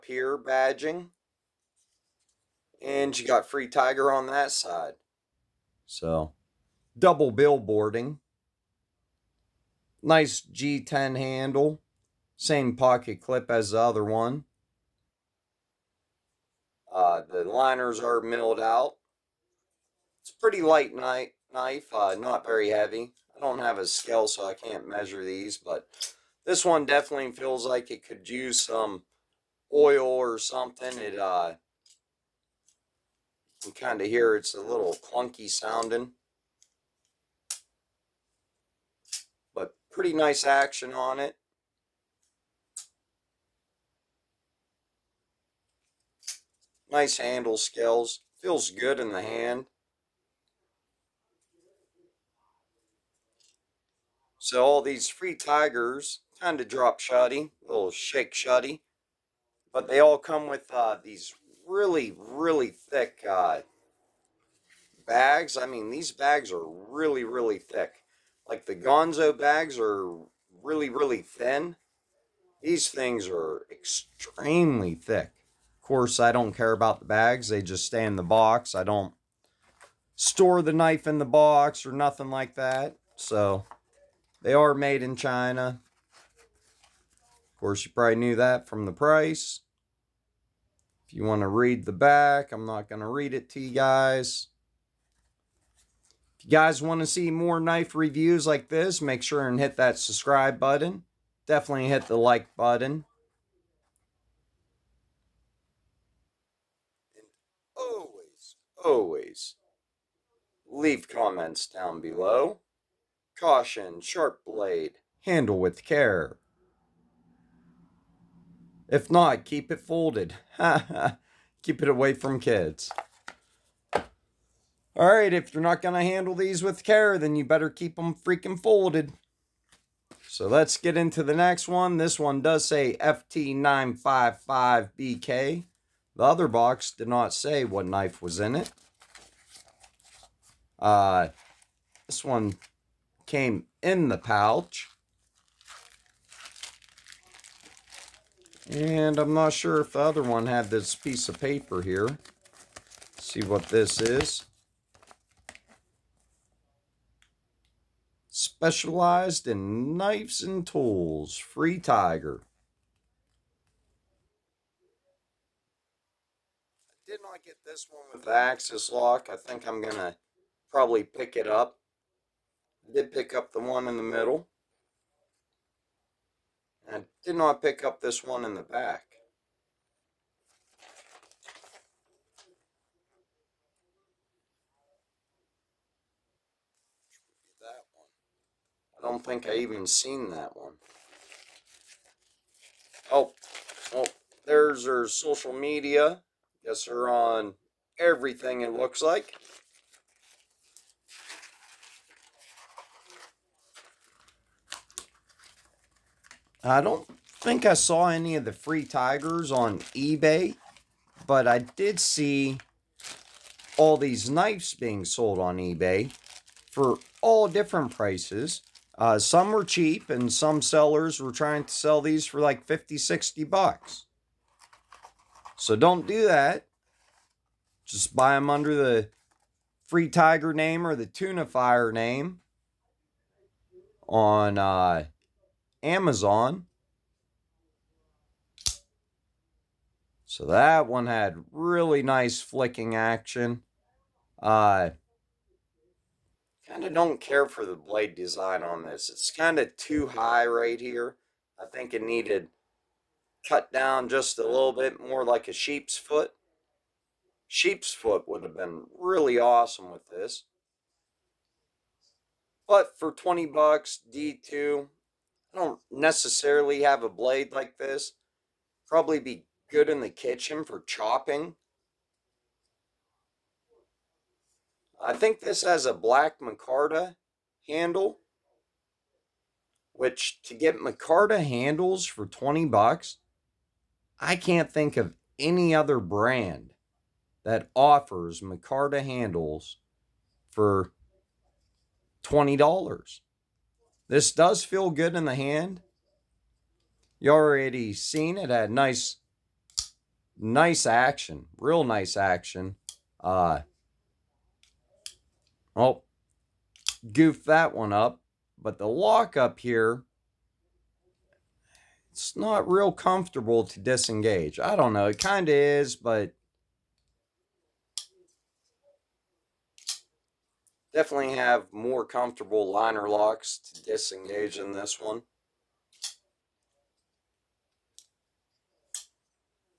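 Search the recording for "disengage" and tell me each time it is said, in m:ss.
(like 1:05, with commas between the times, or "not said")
5:13, 5:23.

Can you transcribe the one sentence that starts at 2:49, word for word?
I think I'm going to probably pick it up.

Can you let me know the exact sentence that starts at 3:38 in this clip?
Uh, some were cheap, and some sellers were trying to sell these for like 50, 60 bucks.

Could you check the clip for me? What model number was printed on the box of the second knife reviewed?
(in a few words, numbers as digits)
FT955BK.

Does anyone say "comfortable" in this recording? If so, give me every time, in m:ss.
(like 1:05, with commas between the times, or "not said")
5:12, 5:22.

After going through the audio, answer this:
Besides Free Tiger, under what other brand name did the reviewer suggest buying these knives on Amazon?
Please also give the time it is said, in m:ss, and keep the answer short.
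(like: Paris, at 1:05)
Tuna Fire, at 3:51.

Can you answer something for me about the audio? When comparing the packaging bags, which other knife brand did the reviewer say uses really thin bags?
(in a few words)
Ganzo.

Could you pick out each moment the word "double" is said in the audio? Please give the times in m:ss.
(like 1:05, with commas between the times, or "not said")
0:06.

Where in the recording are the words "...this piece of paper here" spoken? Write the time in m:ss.
2:30.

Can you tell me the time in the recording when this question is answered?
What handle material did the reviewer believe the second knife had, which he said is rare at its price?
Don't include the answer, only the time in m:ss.
4:35.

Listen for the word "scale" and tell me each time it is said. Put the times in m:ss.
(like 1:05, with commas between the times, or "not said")
0:23, 0:47.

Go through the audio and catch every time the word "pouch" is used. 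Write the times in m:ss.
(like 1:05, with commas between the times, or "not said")
2:24.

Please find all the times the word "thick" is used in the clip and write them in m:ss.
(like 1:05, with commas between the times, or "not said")
1:02, 1:07, 1:14.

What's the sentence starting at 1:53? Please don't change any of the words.
Caution, sharp blade, handle with care.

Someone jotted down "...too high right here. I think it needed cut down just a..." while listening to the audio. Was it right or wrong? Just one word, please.
right.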